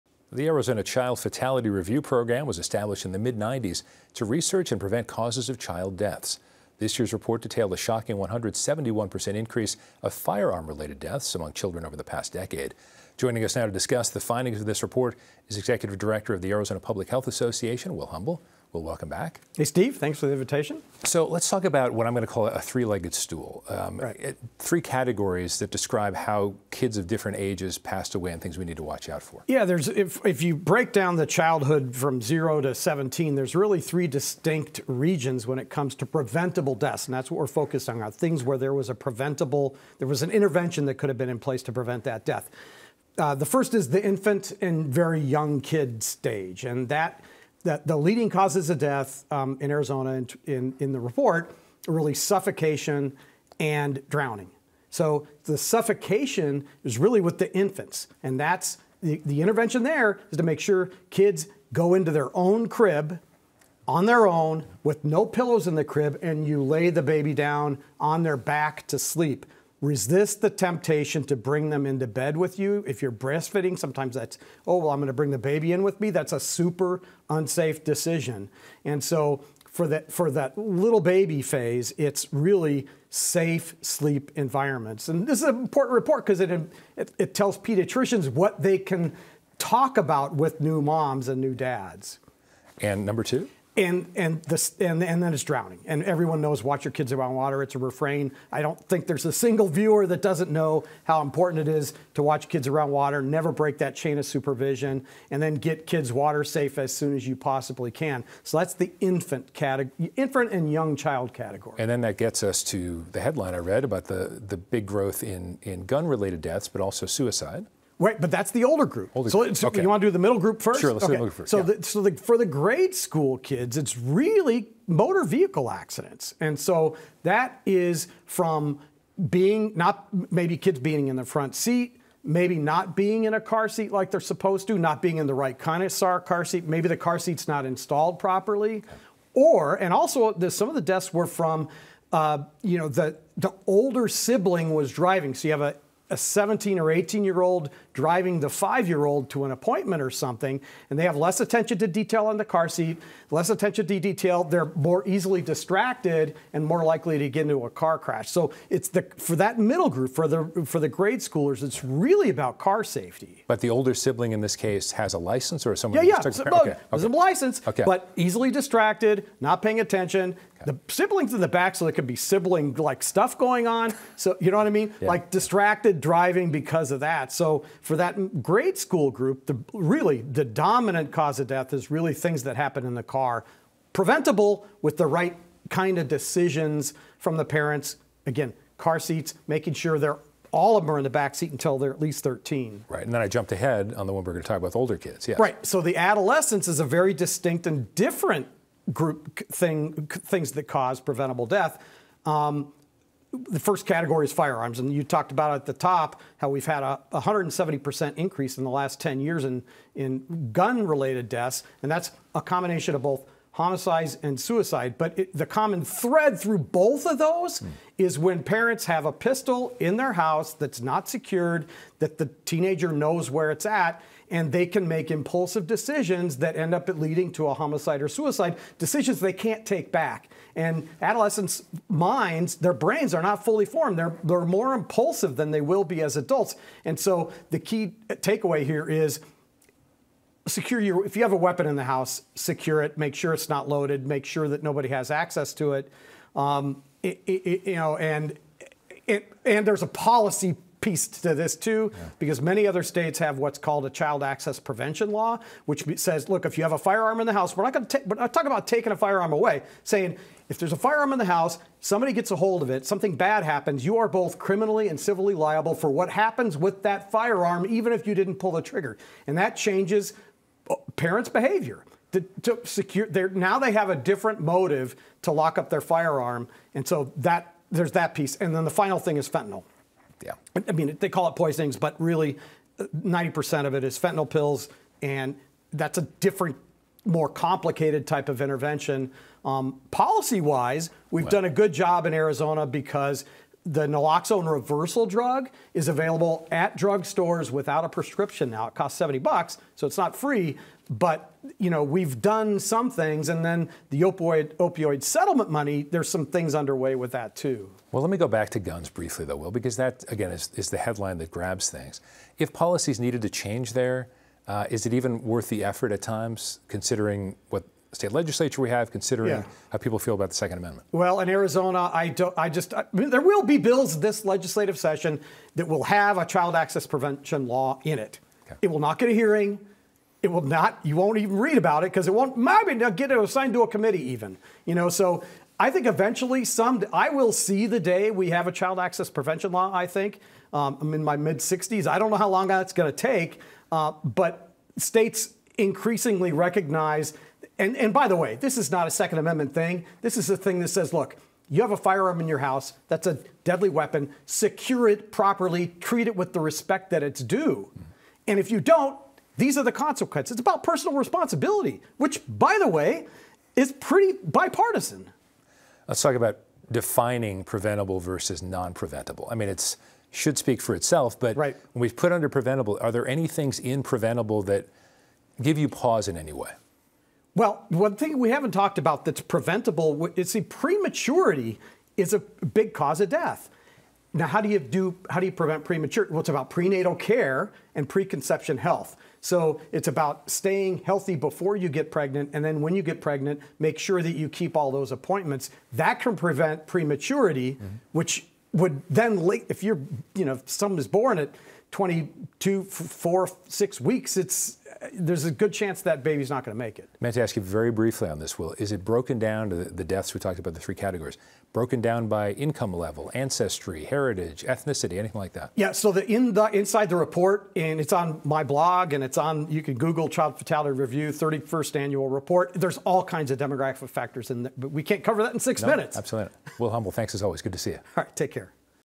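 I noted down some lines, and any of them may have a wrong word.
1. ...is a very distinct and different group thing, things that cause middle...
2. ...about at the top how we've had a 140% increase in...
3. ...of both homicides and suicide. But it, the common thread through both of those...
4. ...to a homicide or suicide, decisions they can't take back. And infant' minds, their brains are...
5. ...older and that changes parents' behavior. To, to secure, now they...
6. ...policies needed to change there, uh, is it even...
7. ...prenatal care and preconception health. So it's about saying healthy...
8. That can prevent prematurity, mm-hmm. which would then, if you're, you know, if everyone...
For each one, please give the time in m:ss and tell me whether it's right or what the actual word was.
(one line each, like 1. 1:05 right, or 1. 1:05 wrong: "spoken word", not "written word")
1. 3:16 wrong: "preventable", not "middle"
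2. 3:25 wrong: "170", not "140"
3. 3:32 right
4. 3:47 wrong: "adolescents", not "infant"
5. 4:28 wrong: "trigger", not "older"
6. 5:12 right
7. 6:26 wrong: "staying", not "saying"
8. 6:35 wrong: "someone", not "everyone".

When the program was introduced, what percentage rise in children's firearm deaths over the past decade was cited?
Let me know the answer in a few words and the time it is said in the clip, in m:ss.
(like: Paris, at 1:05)
171%, at 0:08.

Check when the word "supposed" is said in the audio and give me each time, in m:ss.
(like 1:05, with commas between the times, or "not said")
2:14.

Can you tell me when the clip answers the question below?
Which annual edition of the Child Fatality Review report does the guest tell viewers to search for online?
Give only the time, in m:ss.
7:01.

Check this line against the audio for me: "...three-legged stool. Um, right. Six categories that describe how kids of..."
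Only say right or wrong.
wrong.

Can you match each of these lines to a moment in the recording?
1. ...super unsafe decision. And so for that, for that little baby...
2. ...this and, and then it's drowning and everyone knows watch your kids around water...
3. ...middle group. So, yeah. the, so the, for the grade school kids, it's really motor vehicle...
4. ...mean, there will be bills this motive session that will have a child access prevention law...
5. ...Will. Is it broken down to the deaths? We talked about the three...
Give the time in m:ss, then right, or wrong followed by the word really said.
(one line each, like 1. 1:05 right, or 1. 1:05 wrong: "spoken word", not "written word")
1. 1:16 right
2. 1:34 right
3. 2:01 right
4. 5:22 wrong: "legislative", not "motive"
5. 6:48 right.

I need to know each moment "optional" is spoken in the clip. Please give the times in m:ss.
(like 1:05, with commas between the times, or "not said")
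not said.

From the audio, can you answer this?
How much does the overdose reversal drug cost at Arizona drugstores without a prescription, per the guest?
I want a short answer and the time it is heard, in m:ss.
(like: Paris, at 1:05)
$70, at 4:58.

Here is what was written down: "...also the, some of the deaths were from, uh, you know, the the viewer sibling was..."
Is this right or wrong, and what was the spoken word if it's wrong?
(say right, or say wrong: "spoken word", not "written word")
wrong: "older", not "viewer".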